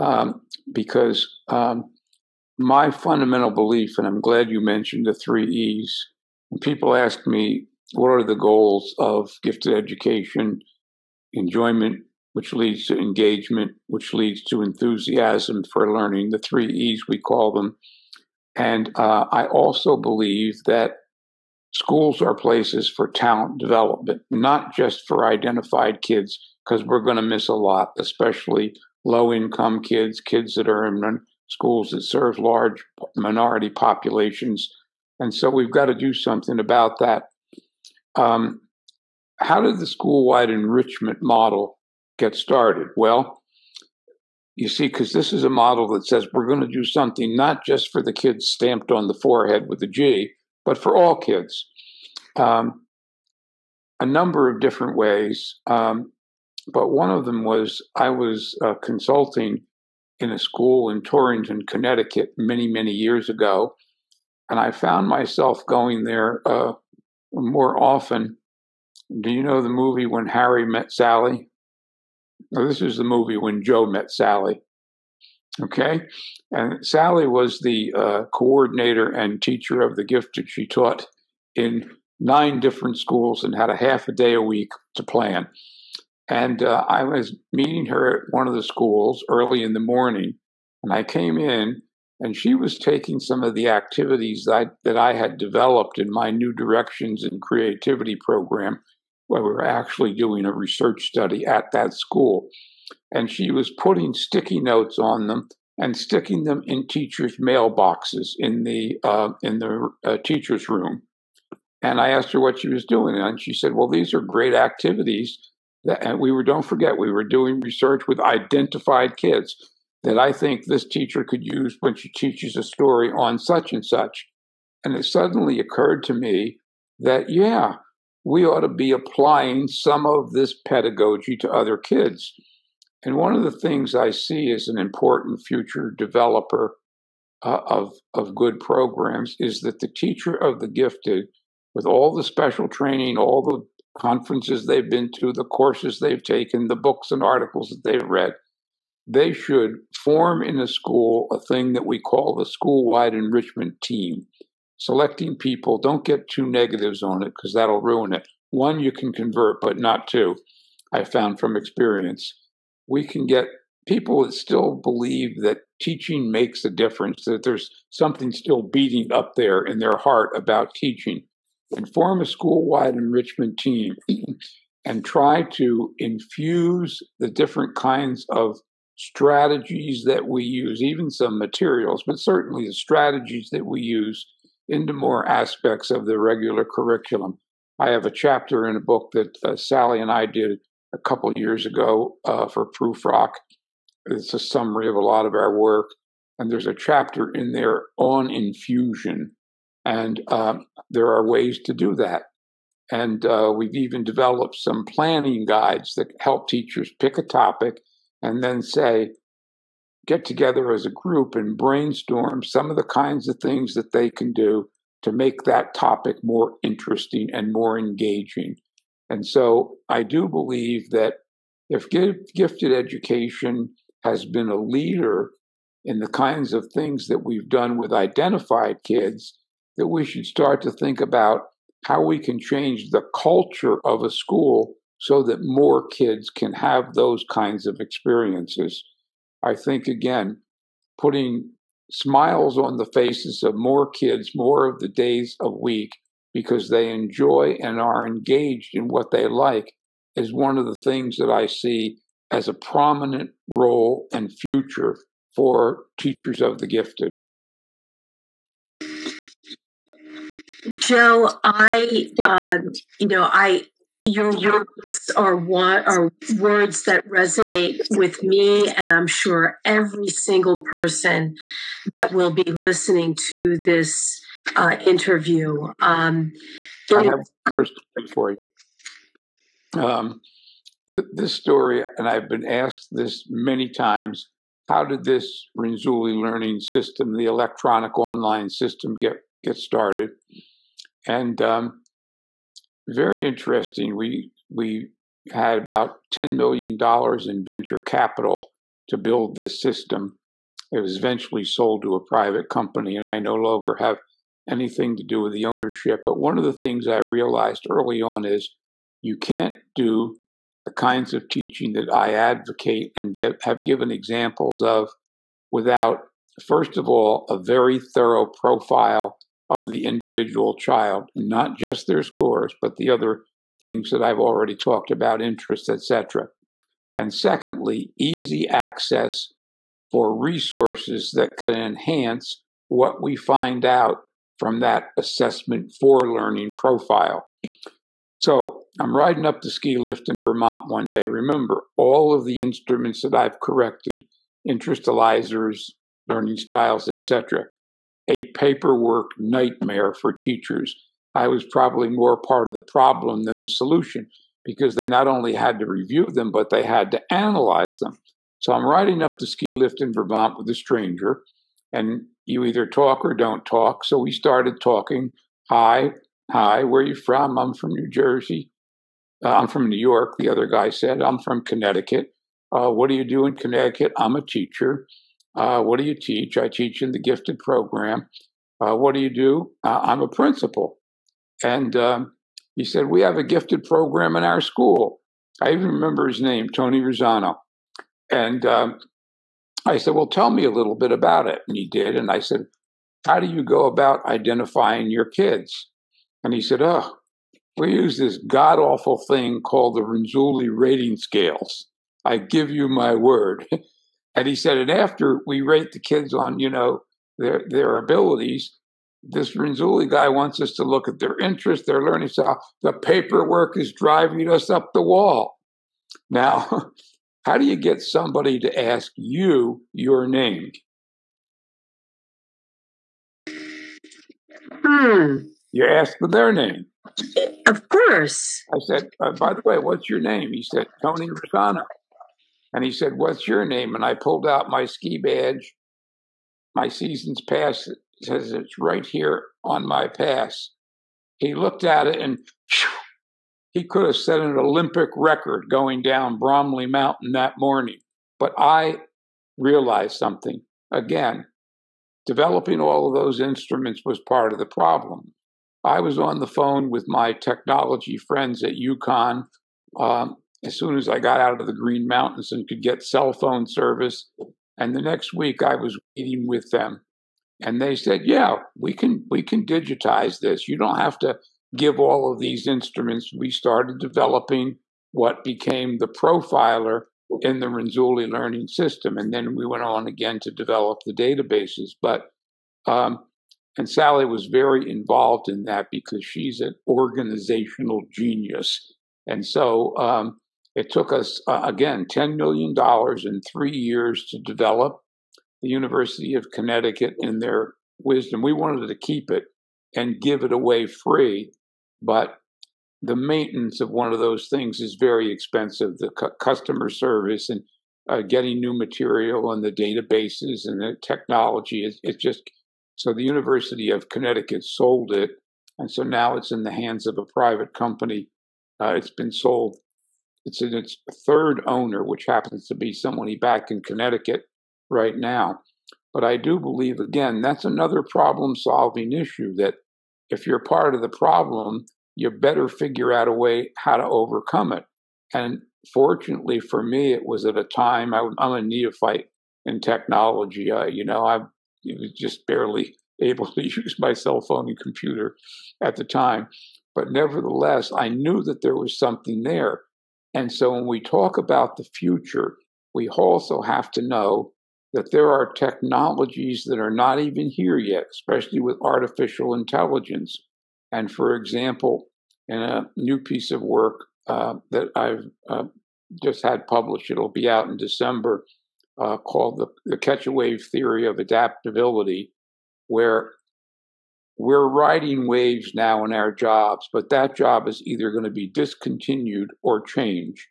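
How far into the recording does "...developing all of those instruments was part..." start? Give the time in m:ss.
7:32.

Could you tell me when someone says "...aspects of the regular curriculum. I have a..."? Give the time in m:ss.
3:05.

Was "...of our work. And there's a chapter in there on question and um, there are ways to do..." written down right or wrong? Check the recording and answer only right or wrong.
wrong.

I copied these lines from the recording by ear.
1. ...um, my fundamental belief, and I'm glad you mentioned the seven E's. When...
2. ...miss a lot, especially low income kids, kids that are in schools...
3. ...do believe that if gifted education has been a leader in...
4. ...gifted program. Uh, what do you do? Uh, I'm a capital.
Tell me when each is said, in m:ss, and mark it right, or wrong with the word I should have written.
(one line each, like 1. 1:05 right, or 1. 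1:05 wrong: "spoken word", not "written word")
1. 0:01 wrong: "three", not "seven"
2. 0:27 right
3. 3:40 right
4. 6:16 wrong: "principal", not "capital".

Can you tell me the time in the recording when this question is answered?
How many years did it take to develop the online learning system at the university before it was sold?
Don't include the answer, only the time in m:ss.
8:13.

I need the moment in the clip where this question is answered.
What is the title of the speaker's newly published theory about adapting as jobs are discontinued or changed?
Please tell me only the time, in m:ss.
9:29.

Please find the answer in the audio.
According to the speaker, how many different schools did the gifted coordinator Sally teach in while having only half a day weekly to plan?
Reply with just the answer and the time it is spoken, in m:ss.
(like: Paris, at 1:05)
9, at 1:22.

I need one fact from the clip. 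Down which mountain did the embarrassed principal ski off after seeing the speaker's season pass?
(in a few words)
Bromley Mountain.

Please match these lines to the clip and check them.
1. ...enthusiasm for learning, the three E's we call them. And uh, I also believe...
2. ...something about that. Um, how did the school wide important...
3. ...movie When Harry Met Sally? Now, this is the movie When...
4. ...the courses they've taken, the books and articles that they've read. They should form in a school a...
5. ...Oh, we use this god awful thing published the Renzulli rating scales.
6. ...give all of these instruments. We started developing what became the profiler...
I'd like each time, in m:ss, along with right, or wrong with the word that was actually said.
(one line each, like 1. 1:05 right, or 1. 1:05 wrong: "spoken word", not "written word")
1. 0:14 right
2. 0:36 wrong: "enrichment", not "important"
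3. 1:09 right
4. 2:25 right
5. 6:36 wrong: "called", not "published"
6. 7:51 right.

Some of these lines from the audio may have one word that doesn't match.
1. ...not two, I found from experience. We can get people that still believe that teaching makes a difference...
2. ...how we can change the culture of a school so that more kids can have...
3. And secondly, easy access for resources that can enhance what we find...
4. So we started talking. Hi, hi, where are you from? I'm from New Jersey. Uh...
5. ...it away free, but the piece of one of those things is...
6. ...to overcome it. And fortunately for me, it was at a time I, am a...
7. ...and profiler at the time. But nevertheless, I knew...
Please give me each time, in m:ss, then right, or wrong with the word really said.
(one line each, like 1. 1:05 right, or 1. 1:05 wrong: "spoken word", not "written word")
1. 2:39 right
2. 3:51 right
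3. 5:26 right
4. 6:03 right
5. 8:20 wrong: "maintenance", not "piece"
6. 8:53 right
7. 9:04 wrong: "computer", not "profiler".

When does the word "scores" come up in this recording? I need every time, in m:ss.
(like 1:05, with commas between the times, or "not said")
5:22.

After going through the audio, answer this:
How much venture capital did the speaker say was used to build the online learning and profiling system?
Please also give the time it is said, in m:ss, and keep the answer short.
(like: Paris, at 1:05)
$10 million, at 4:56.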